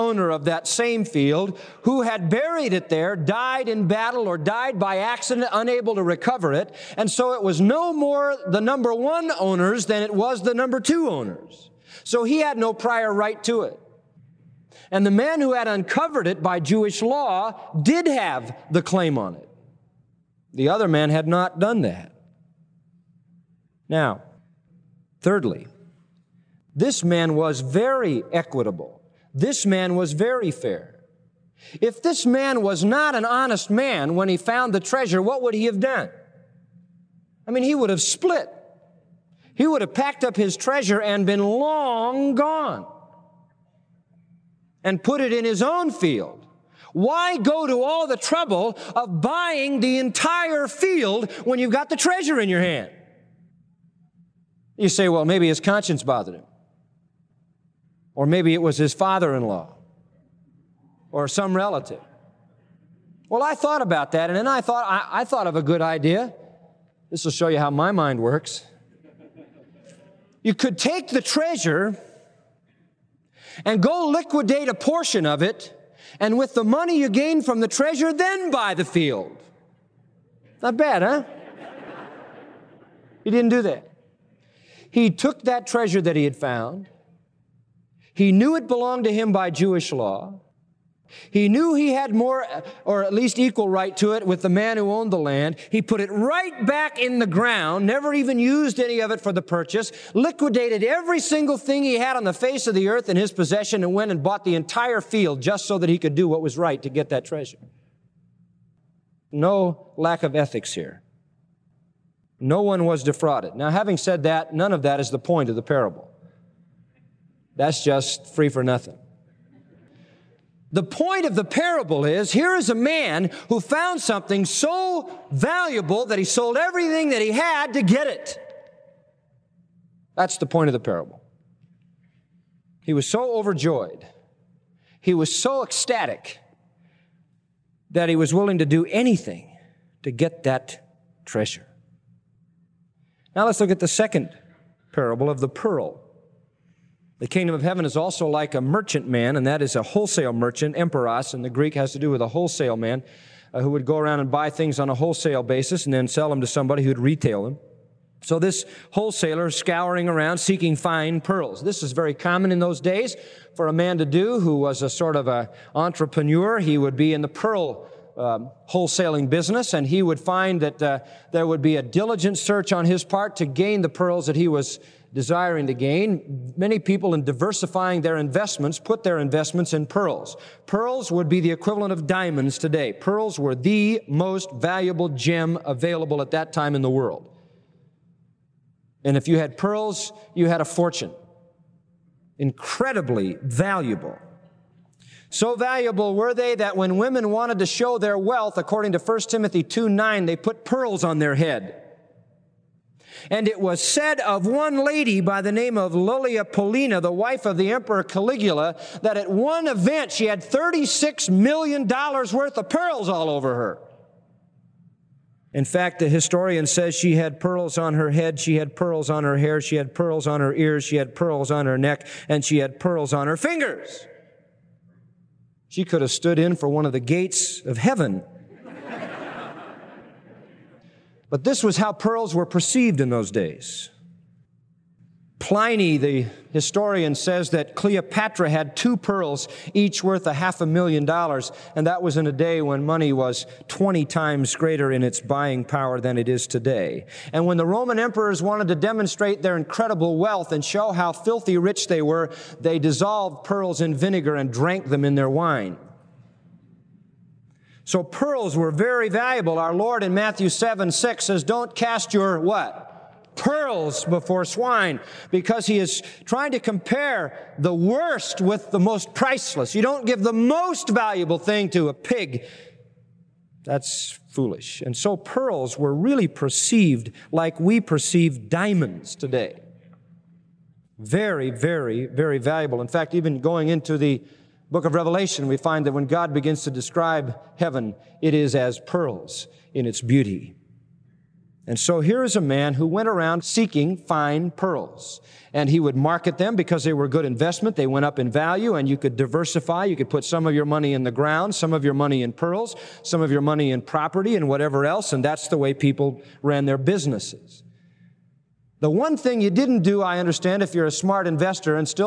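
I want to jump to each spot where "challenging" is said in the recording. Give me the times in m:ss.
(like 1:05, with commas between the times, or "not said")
not said.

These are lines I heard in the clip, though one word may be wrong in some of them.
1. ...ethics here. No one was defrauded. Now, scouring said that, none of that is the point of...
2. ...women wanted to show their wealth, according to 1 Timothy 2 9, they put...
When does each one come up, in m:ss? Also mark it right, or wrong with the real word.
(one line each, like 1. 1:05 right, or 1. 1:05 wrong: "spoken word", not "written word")
1. 1:50 wrong: "having", not "scouring"
2. 3:16 right.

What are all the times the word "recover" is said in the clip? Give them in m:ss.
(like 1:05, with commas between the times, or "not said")
0:06.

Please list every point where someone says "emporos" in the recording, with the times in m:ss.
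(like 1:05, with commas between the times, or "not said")
2:30.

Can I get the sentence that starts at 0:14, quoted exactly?
And the man who had uncovered it by Jewish law did have the claim on it.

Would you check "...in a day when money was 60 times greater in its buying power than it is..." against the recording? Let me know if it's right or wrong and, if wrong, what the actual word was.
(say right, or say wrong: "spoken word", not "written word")
wrong: "20", not "60".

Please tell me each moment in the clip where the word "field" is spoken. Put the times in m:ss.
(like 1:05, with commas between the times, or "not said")
0:01, 0:45, 0:50, 1:18, 1:44.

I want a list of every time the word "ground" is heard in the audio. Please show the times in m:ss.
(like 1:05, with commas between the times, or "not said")
1:37, 5:01.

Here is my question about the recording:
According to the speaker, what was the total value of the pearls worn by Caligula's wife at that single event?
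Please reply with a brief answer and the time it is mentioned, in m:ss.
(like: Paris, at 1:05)
$36 million, at 3:30.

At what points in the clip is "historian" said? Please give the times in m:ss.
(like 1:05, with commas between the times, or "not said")
3:36, 3:56.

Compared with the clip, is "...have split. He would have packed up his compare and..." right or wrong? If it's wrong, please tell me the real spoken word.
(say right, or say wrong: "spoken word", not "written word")
wrong: "treasure", not "compare".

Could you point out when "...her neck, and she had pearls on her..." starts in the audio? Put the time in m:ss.
3:41.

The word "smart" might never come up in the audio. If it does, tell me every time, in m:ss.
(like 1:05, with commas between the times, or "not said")
5:10.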